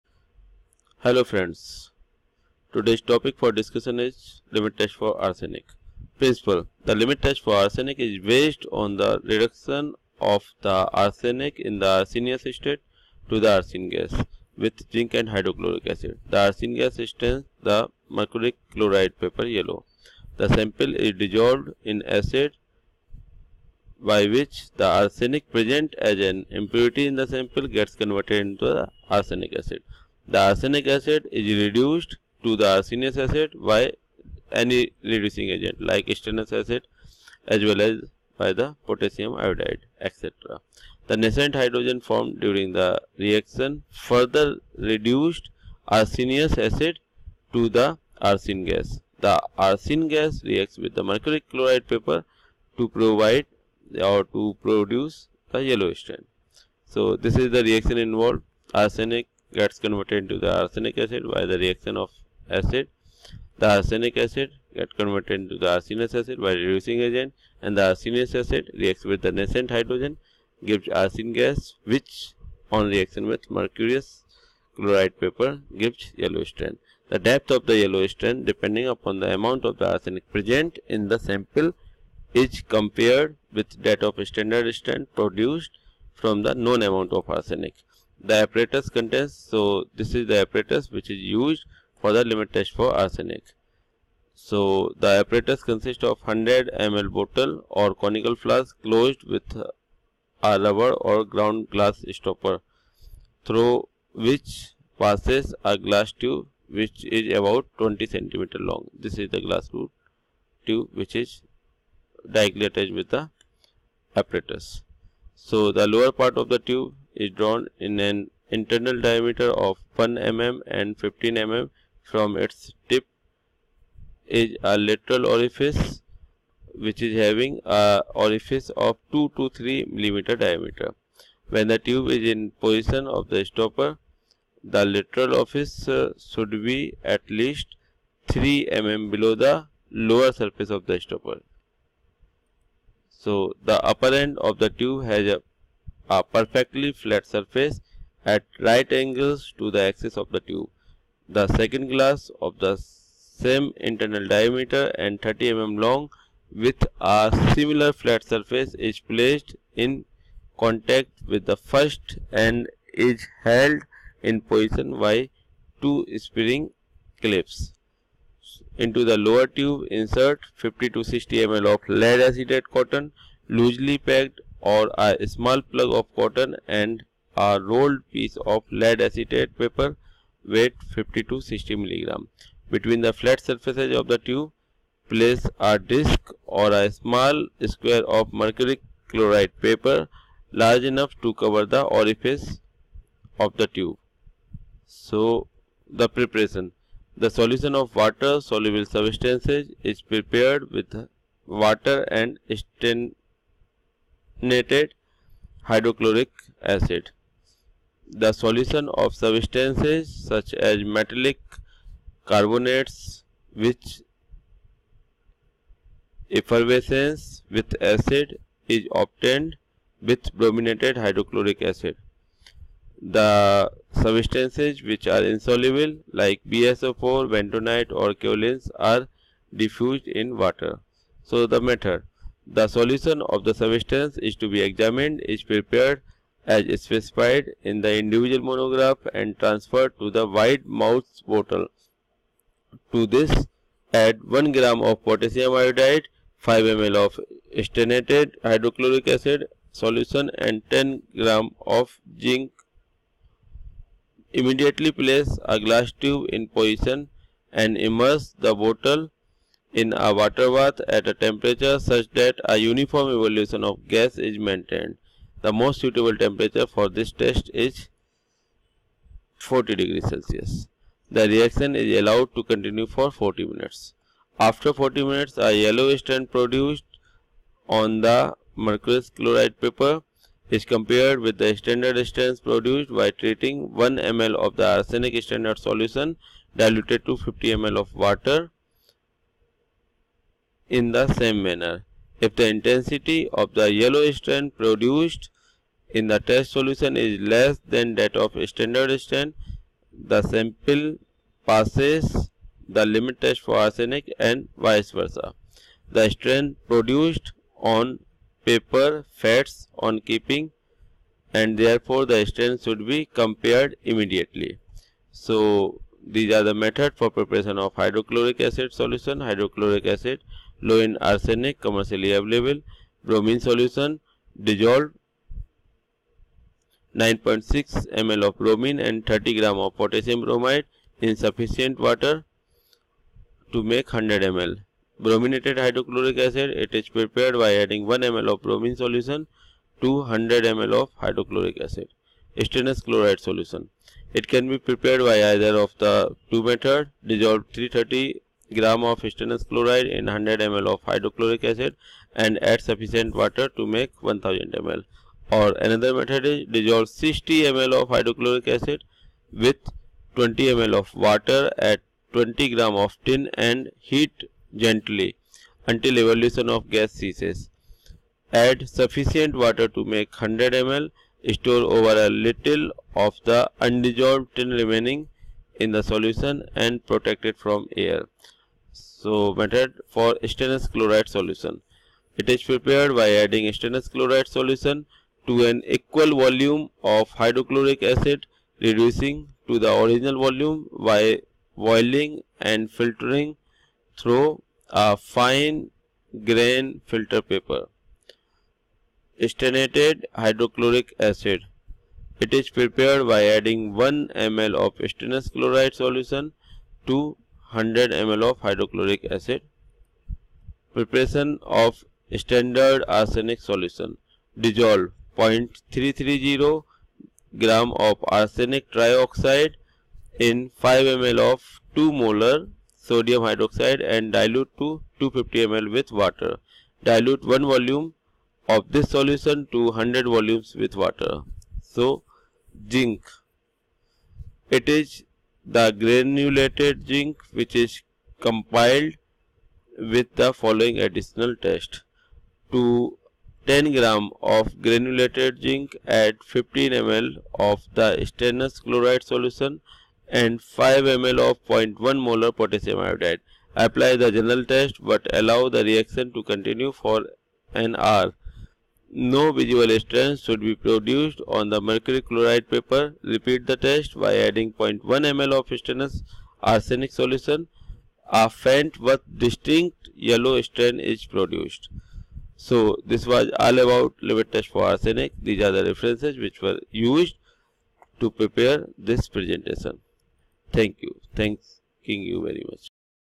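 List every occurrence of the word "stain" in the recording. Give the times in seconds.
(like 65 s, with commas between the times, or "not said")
17 s, 55 s, 202 s, 275 s, 282 s, 459 s, 470 s.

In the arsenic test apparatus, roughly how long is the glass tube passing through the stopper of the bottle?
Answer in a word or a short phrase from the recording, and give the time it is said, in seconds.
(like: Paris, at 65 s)
20 centimeters, at 107 s.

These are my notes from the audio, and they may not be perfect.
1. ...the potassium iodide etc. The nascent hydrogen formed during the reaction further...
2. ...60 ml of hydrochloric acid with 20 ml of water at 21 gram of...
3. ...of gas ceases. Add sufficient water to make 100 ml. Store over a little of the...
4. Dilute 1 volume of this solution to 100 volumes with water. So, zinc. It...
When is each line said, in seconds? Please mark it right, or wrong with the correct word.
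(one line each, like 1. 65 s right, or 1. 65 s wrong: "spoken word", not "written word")
1. 38 s right
2. 356 s wrong: "20", not "21"
3. 366 s right
4. 426 s right.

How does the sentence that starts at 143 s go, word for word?
So the upper end of the tube has a a perfectly flat surface at right angles to the axis of the tube.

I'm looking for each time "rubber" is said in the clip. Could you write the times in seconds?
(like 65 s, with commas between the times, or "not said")
100 s.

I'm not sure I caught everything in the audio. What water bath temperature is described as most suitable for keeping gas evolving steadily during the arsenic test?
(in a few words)
40 degrees Celsius.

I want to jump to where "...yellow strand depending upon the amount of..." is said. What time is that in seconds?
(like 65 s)
77 s.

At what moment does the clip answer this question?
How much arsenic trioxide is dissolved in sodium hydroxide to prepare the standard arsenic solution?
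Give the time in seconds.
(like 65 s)
415 s.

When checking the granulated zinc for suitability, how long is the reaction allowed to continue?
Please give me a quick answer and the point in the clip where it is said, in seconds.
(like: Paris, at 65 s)
An hour, at 457 s.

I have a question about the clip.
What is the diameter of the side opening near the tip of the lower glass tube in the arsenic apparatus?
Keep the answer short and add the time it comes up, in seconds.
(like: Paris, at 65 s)
2 to 3 millimeters, at 129 s.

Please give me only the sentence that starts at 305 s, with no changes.
The strain produced on paper fats on keeping and therefore the strain should be compared immediately.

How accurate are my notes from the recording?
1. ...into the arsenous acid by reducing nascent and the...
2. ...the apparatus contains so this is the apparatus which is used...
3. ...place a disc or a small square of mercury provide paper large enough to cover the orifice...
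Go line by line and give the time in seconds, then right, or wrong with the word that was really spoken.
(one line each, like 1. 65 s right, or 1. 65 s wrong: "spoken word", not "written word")
1. 65 s wrong: "agent", not "nascent"
2. 88 s right
3. 185 s wrong: "chloride", not "provide".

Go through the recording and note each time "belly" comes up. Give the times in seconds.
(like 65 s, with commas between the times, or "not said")
not said.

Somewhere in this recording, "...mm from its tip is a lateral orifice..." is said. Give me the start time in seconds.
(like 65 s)
121 s.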